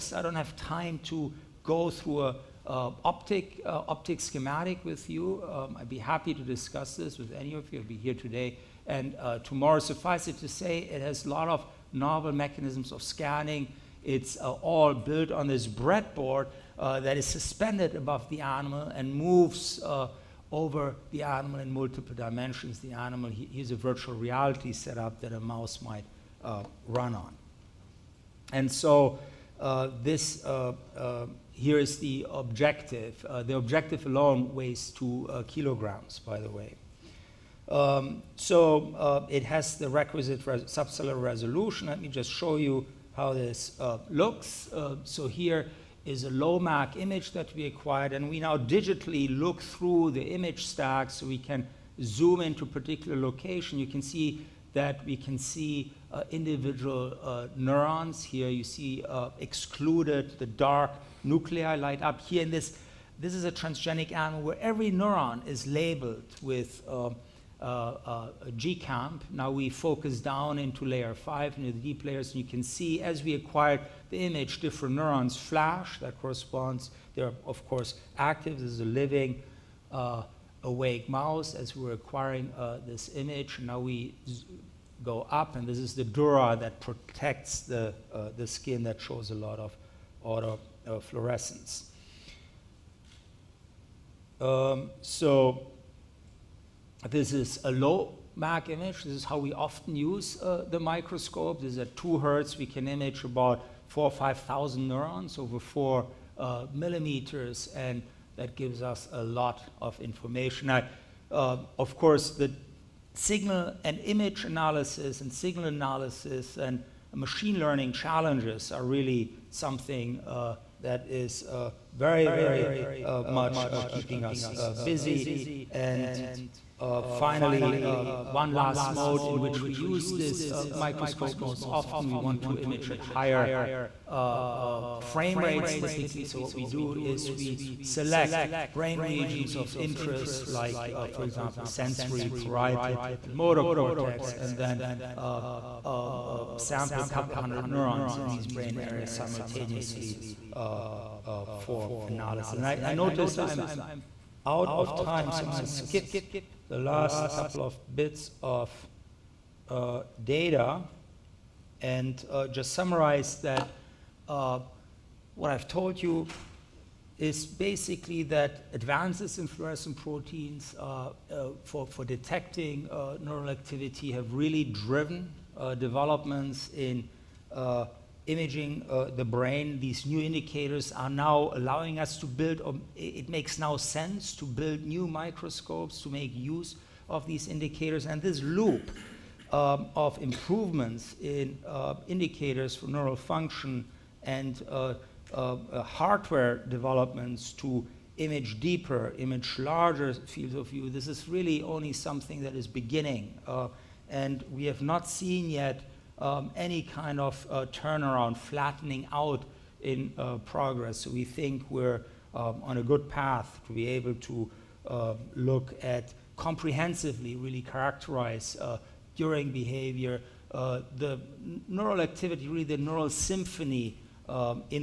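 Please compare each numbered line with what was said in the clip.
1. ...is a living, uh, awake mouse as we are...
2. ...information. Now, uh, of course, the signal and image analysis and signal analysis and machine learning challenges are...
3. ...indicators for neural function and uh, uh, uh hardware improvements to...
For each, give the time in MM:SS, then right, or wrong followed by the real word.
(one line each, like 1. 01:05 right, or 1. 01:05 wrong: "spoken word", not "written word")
1. 01:18 right
2. 01:49 right
3. 03:12 wrong: "developments", not "improvements".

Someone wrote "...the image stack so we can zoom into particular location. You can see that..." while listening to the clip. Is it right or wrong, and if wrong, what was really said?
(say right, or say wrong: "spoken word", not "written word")
right.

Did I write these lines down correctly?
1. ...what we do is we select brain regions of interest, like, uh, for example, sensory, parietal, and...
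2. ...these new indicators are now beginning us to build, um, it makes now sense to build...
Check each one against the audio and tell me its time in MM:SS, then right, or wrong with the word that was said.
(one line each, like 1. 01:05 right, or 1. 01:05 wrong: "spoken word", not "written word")
1. 02:16 right
2. 02:59 wrong: "allowing", not "beginning".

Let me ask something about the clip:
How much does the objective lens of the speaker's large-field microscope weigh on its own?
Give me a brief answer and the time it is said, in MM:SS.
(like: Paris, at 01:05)
2 kilograms, at 00:34.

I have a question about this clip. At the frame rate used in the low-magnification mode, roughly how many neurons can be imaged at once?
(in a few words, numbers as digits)
4 or 5,000.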